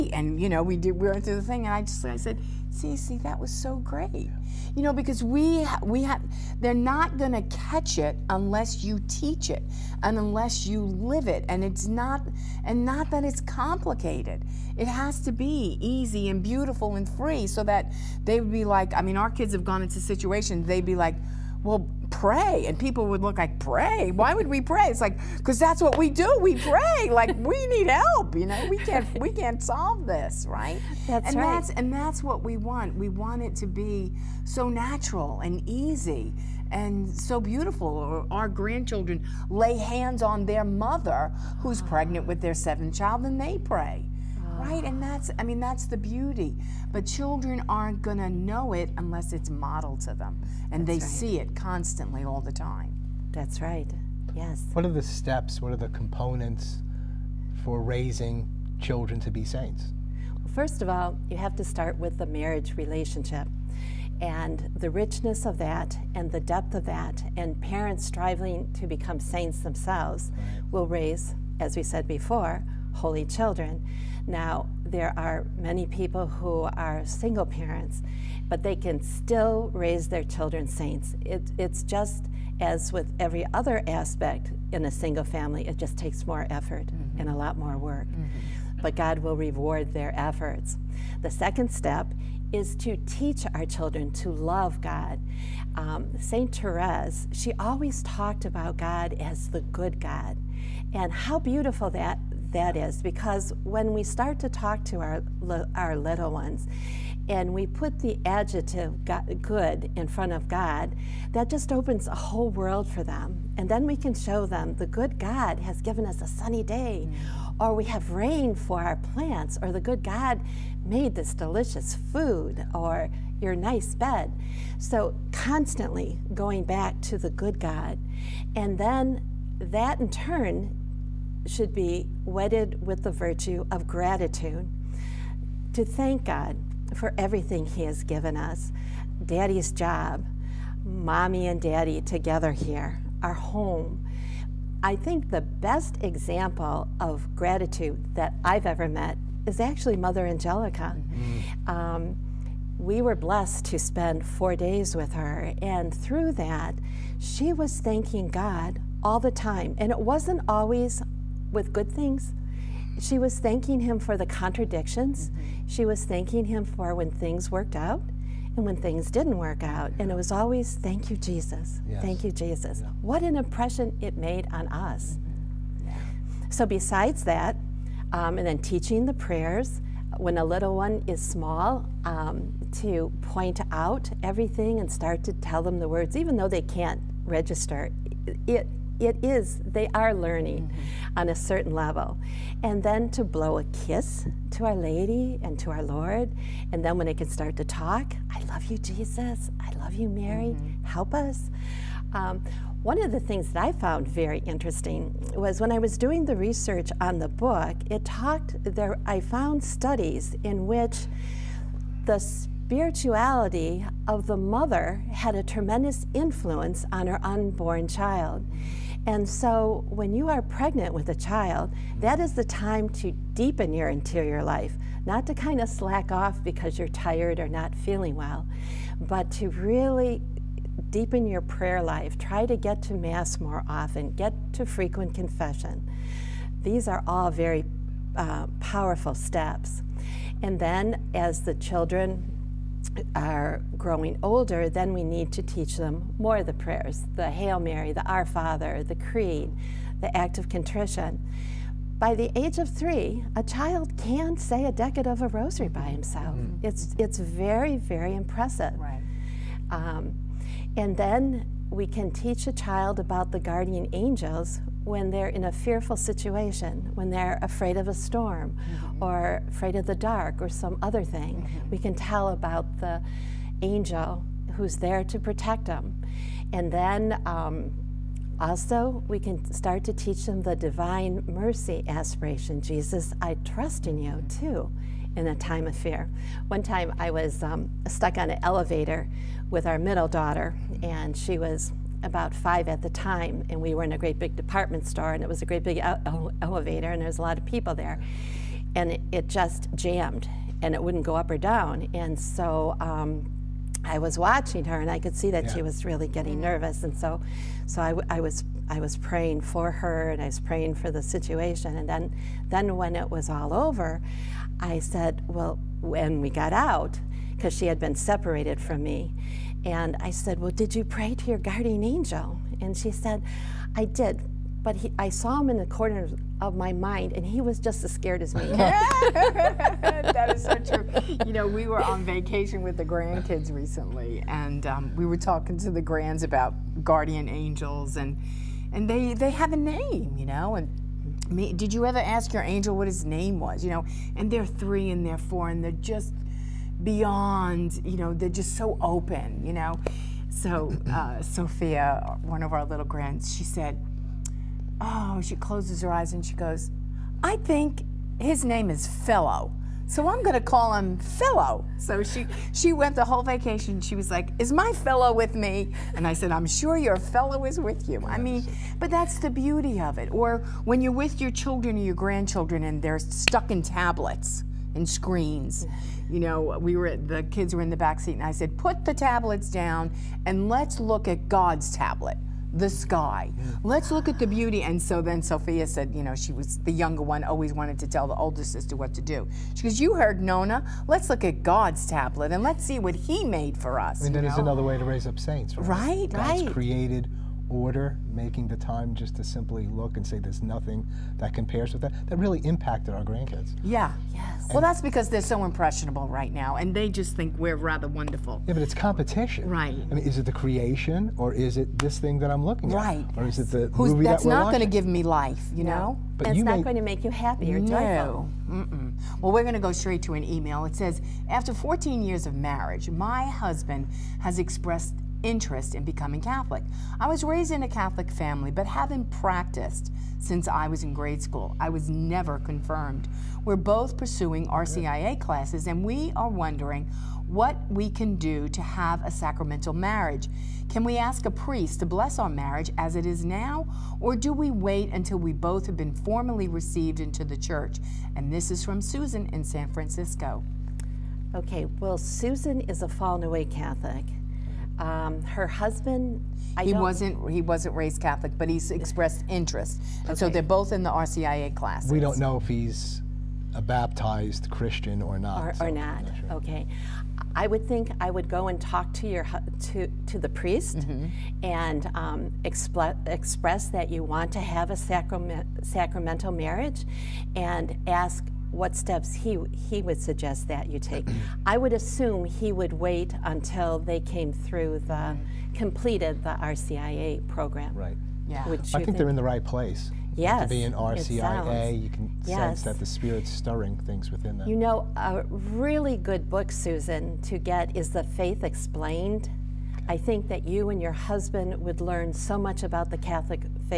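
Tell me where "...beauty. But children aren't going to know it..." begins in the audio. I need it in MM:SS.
00:45.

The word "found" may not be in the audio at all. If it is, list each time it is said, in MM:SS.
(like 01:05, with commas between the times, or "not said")
03:23, 03:29.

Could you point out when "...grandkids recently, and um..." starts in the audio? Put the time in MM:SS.
05:32.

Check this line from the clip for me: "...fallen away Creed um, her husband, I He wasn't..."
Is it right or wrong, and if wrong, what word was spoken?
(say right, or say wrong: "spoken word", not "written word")
wrong: "Catholic", not "Creed".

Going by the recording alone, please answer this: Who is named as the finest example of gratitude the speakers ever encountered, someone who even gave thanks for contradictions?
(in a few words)
Mother Angelica.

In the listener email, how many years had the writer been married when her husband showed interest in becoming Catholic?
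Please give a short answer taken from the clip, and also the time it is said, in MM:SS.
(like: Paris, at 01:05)
14, at 07:01.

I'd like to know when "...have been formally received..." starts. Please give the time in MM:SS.
07:25.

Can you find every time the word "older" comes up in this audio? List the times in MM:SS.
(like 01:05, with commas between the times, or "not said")
04:04, 06:28.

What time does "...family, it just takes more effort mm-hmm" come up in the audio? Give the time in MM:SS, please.
01:25.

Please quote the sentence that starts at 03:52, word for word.
Try to get to Mass more often, get to frequent confession.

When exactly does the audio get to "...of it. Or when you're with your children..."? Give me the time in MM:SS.
06:09.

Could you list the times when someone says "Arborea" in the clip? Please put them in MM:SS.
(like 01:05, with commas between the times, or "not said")
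not said.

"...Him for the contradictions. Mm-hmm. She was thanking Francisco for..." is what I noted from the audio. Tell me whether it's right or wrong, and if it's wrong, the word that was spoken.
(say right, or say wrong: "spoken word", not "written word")
wrong: "Him", not "Francisco".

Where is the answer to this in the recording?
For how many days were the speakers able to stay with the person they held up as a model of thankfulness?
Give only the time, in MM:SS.
02:34.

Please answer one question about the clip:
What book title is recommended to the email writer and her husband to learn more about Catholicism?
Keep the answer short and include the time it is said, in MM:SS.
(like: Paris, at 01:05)
The Faith Explained, at 08:17.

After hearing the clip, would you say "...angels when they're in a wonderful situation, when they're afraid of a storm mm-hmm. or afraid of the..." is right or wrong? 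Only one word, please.
wrong.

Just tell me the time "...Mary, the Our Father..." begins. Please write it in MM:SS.
04:07.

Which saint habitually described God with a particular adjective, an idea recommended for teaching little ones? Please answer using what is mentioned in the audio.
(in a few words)
Saint Therese.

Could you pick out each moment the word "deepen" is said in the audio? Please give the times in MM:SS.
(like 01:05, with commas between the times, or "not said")
03:43, 03:50.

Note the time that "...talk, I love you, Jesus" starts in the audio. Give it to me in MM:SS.
03:17.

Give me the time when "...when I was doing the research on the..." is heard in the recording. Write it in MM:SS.
03:25.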